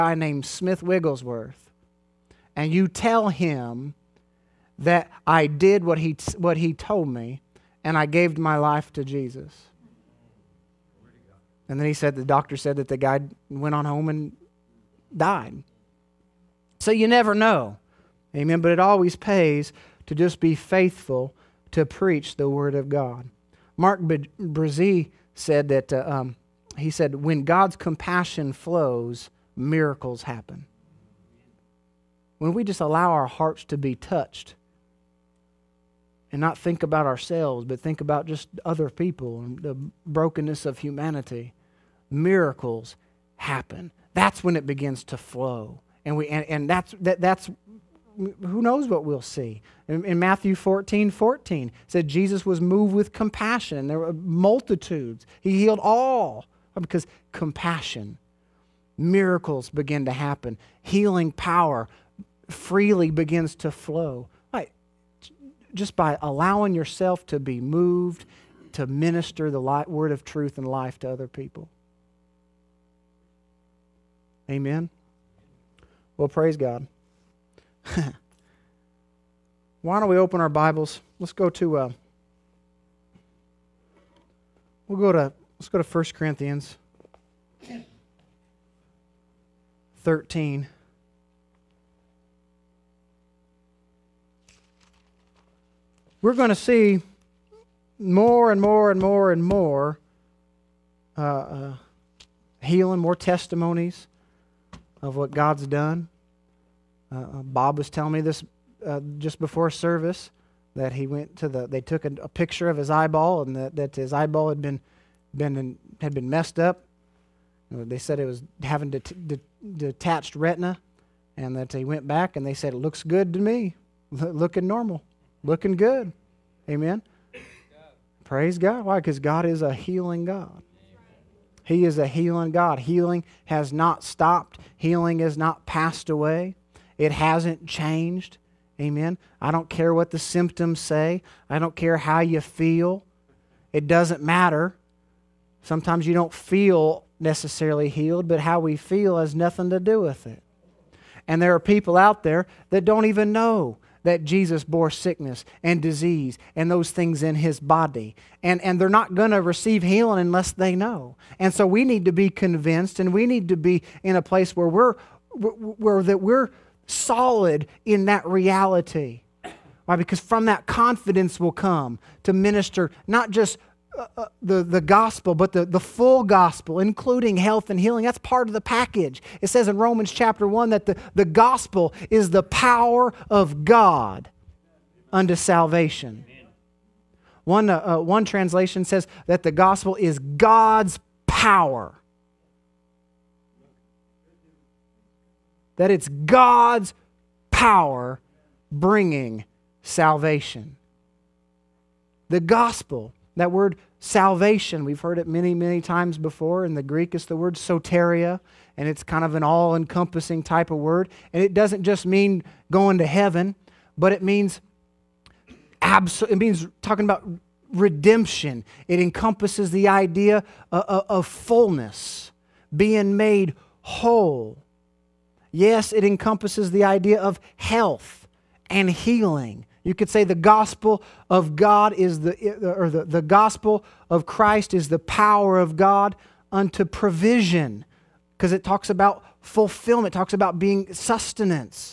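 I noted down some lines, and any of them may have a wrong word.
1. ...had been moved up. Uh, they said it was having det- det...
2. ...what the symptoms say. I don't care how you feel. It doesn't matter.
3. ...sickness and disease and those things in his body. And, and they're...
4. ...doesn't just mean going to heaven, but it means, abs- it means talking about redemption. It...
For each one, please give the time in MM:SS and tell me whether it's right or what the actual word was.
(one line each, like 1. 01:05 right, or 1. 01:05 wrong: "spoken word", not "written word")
1. 01:55 wrong: "messed", not "moved"
2. 02:19 right
3. 02:34 right
4. 03:31 right.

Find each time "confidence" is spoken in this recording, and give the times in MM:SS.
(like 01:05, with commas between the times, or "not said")
02:50.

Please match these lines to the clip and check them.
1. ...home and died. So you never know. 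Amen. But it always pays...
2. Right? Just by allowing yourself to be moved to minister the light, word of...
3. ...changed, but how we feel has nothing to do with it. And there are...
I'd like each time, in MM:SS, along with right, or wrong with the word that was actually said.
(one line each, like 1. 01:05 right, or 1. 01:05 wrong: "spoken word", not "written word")
1. 00:13 right
2. 01:04 right
3. 02:27 wrong: "healed", not "changed".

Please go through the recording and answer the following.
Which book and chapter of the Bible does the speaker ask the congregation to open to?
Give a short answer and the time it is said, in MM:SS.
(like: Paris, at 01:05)
1 Corinthians 13, at 01:25.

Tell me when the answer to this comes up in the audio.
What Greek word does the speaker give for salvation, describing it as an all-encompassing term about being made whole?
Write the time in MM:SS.
03:27.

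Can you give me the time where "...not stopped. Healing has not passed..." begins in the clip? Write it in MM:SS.
02:13.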